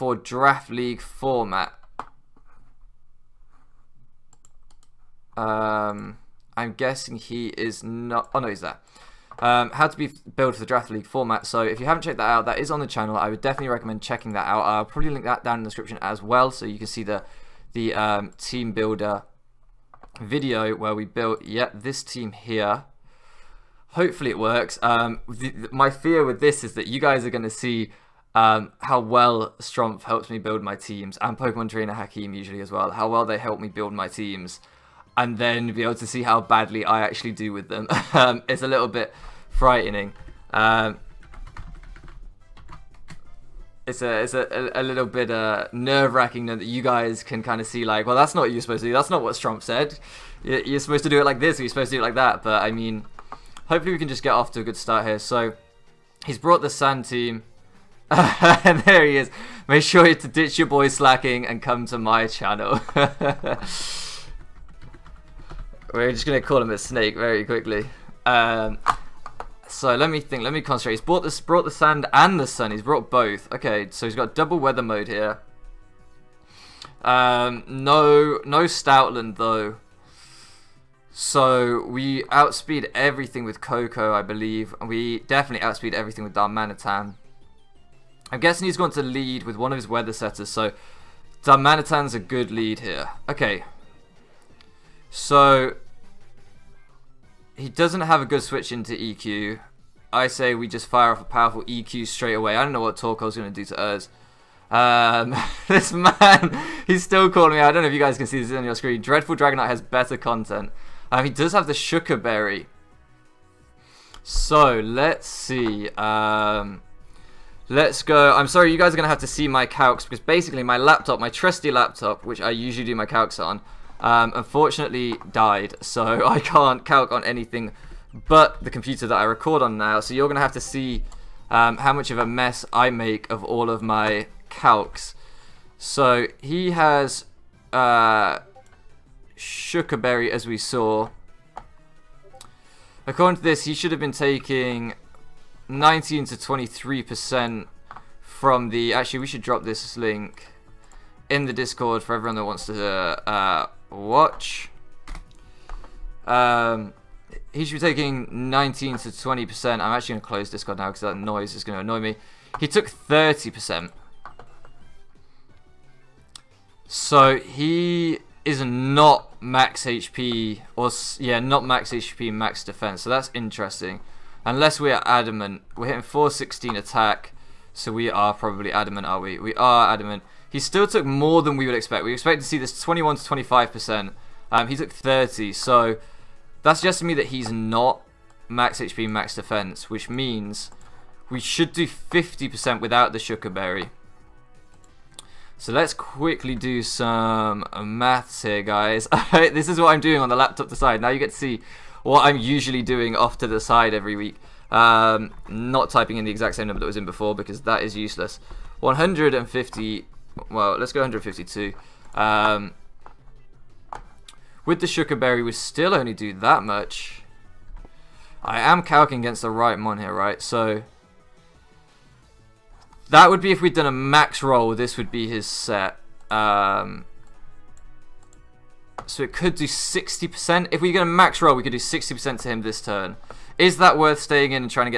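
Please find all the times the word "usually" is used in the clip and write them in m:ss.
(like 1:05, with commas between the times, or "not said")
0:32, 2:02, 3:22.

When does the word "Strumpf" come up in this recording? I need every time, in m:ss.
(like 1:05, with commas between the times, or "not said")
0:29.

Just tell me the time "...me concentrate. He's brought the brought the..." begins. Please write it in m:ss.
1:10.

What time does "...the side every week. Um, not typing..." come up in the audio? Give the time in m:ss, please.
3:23.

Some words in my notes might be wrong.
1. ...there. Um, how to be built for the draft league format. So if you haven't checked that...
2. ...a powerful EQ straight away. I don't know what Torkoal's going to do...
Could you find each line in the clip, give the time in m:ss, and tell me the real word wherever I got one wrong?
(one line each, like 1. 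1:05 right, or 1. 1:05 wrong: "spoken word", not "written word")
1. 0:08 right
2. 1:41 right.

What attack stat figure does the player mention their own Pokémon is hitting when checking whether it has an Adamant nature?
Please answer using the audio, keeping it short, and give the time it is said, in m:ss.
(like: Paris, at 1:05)
416, at 2:56.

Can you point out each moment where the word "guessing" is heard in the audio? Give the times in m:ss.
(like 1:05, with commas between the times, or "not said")
0:06, 1:28.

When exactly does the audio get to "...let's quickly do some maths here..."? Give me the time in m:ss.
3:15.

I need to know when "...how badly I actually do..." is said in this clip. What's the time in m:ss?
0:36.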